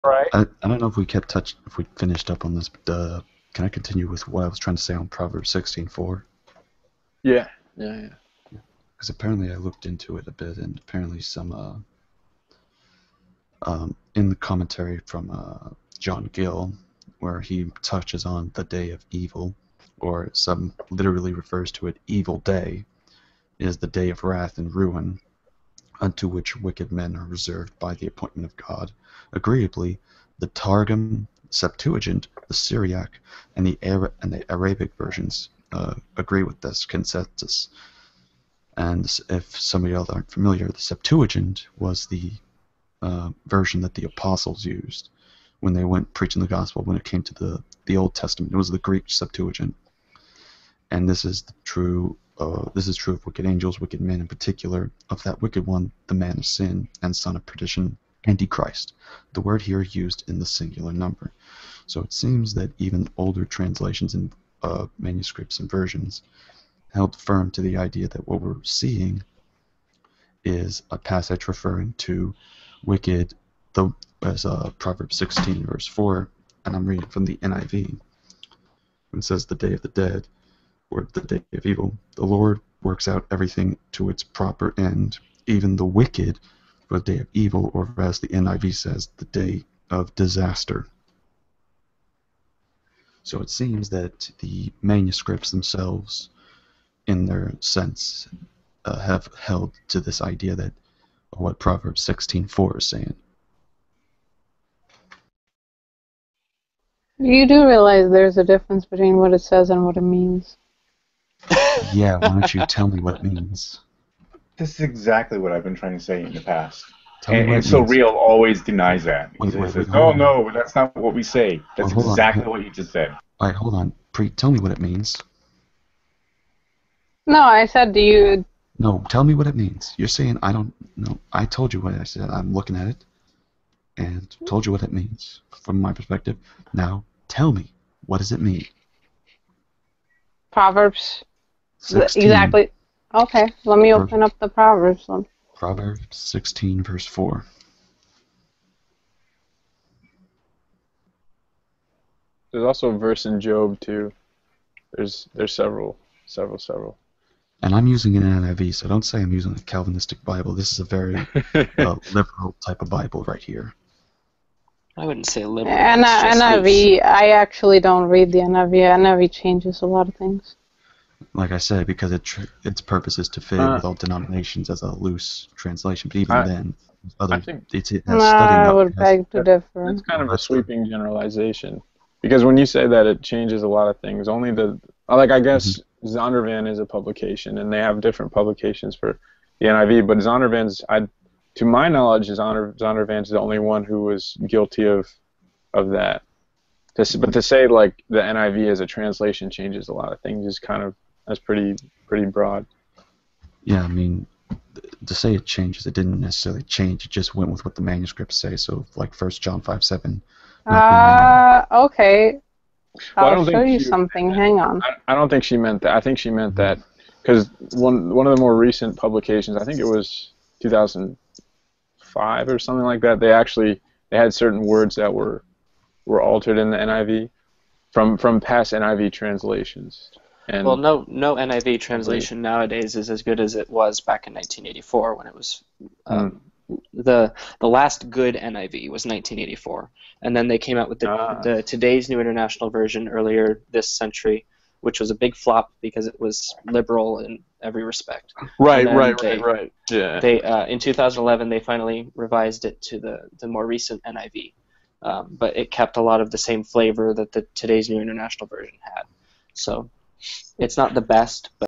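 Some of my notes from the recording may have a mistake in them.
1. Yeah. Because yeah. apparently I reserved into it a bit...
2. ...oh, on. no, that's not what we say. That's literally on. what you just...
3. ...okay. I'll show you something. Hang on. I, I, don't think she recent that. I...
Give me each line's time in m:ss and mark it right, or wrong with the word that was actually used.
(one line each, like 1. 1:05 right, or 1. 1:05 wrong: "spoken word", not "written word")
1. 0:08 wrong: "looked", not "reserved"
2. 1:59 wrong: "exactly", not "literally"
3. 3:31 wrong: "meant", not "recent".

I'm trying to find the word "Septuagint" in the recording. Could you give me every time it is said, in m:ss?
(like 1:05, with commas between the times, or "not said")
0:31, 0:40, 0:49.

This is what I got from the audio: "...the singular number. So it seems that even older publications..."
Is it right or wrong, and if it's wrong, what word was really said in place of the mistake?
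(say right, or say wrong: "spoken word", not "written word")
wrong: "translations", not "publications".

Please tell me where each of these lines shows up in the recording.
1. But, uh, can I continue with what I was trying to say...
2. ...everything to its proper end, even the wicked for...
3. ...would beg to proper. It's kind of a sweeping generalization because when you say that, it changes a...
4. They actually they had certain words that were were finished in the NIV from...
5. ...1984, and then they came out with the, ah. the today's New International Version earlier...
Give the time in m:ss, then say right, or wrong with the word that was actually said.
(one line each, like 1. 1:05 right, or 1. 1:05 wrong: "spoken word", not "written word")
1. 0:02 right
2. 1:23 right
3. 2:58 wrong: "differ", not "proper"
4. 3:43 wrong: "altered", not "finished"
5. 3:59 right.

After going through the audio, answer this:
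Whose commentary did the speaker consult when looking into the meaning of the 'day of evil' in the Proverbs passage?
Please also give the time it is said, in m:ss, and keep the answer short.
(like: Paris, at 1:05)
John Gill, at 0:15.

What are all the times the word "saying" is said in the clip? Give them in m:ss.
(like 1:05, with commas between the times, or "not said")
1:42, 2:10.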